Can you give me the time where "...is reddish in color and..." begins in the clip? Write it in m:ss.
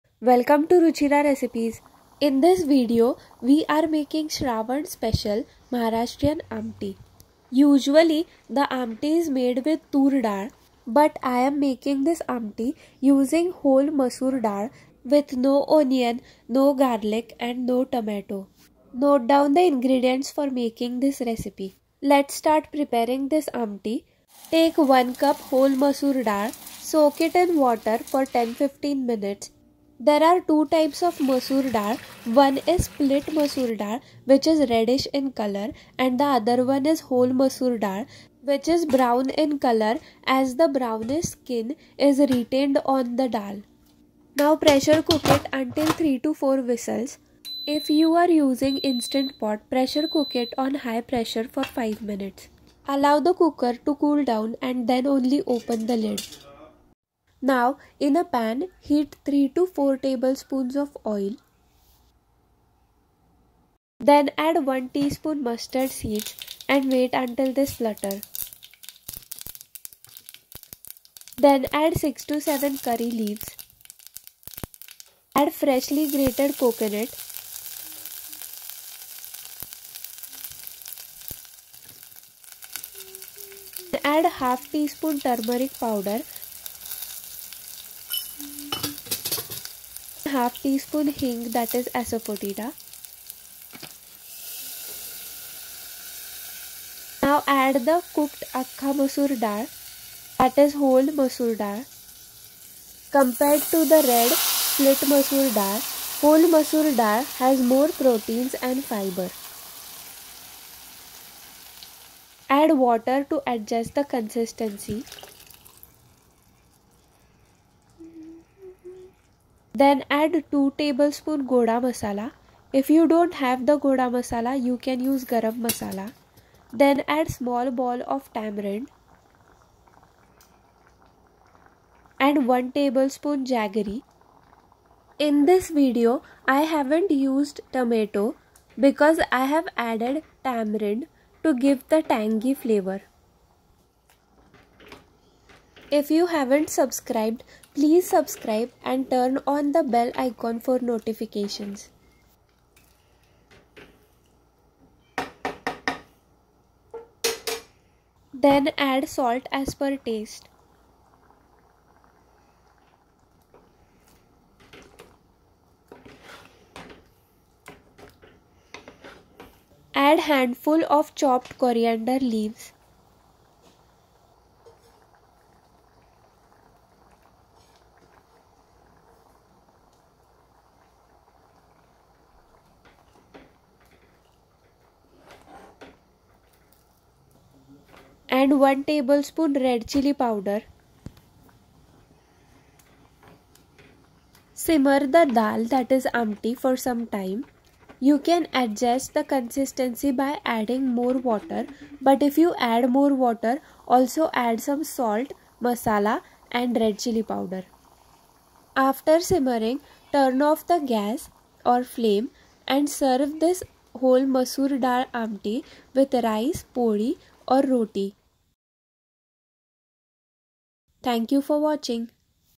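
0:34.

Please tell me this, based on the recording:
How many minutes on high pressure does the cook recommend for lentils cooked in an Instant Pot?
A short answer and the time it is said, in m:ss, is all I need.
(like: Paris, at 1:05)
5 minutes, at 0:51.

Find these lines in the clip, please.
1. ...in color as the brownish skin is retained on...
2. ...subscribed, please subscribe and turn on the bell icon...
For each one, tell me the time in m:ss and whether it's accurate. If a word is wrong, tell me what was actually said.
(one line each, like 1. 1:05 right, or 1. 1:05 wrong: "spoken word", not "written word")
1. 0:39 right
2. 2:26 right.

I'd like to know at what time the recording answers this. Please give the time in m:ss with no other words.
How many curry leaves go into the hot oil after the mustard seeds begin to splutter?
1:11.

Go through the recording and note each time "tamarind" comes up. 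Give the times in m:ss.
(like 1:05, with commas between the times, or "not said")
2:08, 2:20.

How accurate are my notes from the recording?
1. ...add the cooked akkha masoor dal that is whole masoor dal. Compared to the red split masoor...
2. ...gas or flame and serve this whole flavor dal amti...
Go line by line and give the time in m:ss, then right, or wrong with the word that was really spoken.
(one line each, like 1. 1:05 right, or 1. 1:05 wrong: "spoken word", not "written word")
1. 1:37 right
2. 3:30 wrong: "masoor", not "flavor".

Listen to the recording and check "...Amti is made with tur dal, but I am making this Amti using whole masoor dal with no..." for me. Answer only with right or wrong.
right.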